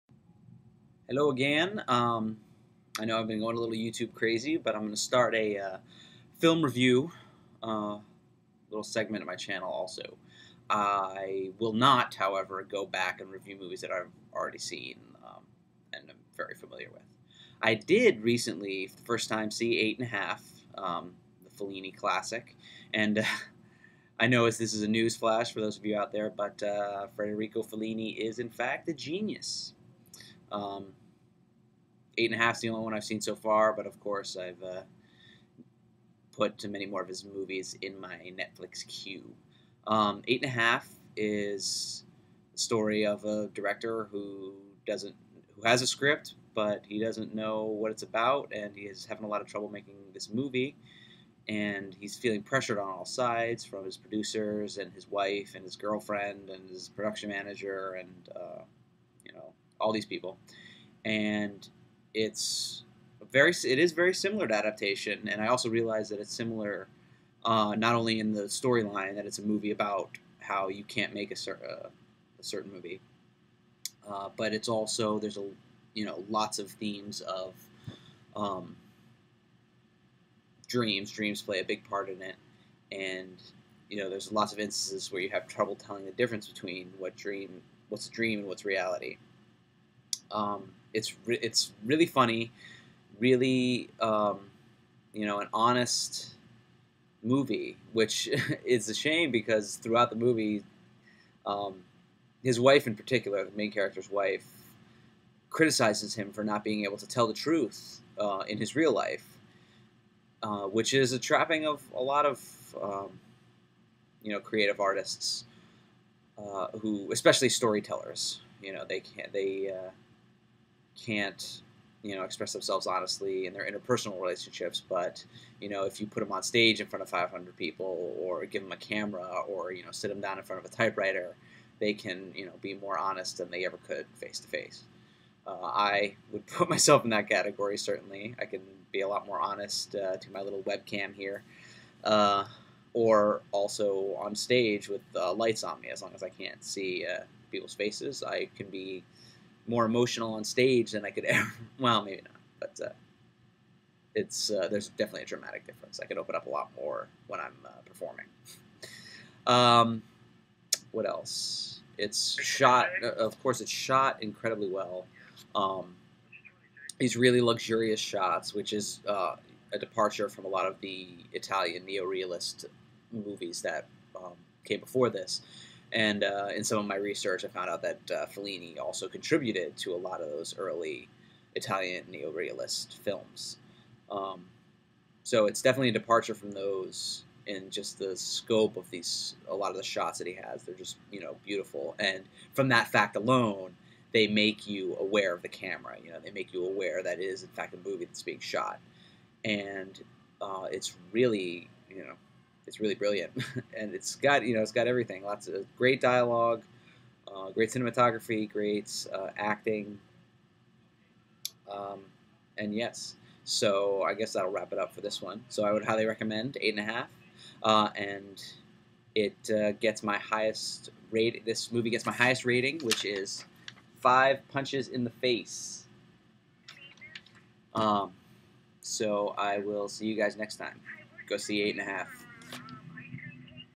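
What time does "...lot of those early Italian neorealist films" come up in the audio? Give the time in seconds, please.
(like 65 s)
179 s.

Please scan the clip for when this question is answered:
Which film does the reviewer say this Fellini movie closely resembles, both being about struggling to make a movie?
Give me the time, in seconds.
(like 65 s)
64 s.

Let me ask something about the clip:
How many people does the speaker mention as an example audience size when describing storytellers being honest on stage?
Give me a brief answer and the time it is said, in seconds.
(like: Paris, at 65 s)
500, at 127 s.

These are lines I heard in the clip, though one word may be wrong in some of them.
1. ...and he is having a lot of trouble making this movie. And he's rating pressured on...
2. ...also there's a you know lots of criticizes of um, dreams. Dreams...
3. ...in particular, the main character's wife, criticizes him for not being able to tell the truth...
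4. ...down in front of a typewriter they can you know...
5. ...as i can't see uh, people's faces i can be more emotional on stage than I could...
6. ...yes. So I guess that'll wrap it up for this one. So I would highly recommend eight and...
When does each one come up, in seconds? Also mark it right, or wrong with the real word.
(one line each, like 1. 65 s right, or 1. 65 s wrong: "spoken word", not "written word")
1. 48 s wrong: "feeling", not "rating"
2. 74 s wrong: "themes", not "criticizes"
3. 102 s right
4. 130 s right
5. 146 s right
6. 212 s right.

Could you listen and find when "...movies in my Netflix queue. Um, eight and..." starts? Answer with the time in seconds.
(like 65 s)
37 s.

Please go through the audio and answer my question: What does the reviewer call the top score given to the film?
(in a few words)
five punches in the face.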